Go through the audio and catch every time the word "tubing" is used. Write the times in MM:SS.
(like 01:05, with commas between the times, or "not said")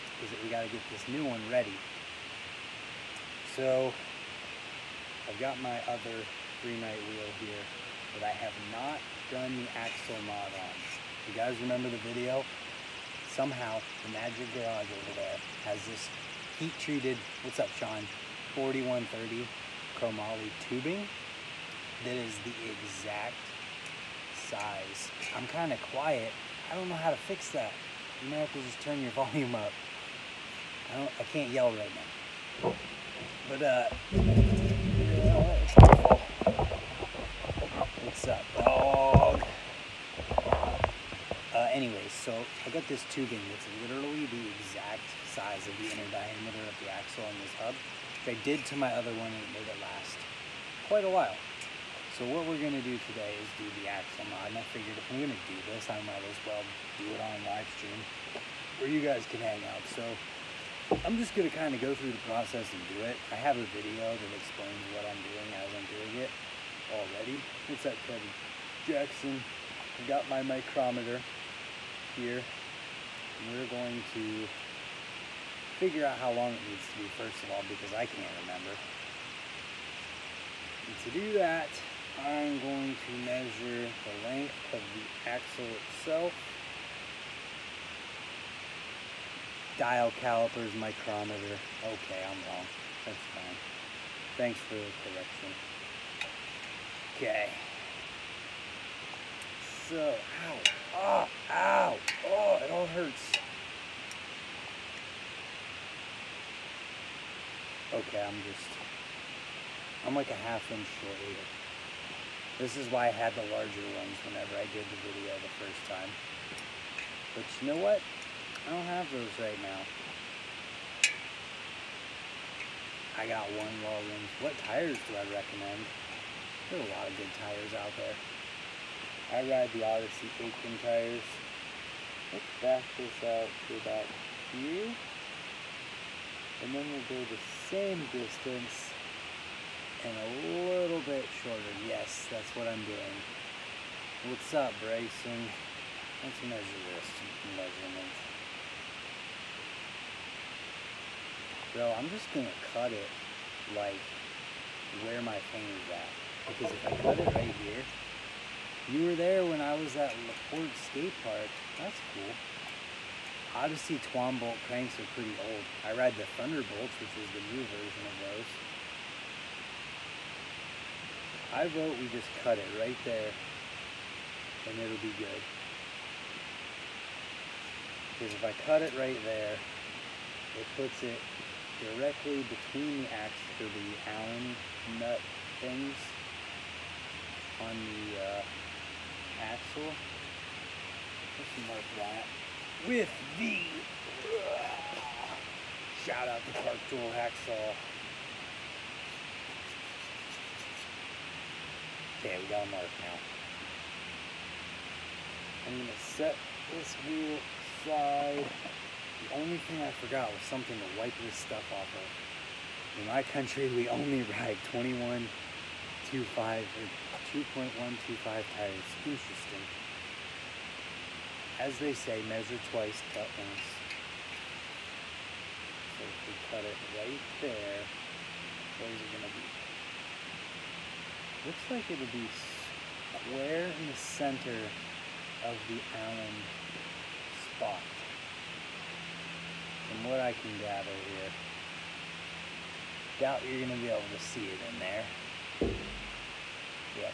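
00:20, 00:43.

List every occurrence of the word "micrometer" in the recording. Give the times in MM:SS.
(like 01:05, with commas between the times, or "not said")
01:10, 01:30.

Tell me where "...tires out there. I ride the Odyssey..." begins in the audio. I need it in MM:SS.
02:07.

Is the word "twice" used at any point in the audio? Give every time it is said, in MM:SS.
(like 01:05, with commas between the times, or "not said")
03:42.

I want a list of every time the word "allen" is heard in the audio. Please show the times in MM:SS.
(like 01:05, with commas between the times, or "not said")
03:04, 03:55.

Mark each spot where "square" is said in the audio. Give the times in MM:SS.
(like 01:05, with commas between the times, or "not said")
03:53.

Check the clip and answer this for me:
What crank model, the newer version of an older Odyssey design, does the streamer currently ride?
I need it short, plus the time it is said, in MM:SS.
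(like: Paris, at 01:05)
Thunderbolts, at 02:46.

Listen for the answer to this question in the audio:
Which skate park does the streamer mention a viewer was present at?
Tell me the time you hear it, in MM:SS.
02:40.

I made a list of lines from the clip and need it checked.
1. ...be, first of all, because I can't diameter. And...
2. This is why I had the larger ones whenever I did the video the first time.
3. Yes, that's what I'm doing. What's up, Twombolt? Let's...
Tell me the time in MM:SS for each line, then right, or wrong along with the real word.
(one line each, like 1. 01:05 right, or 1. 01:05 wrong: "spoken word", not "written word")
1. 01:16 wrong: "remember", not "diameter"
2. 01:52 right
3. 02:21 wrong: "Brayson", not "Twombolt".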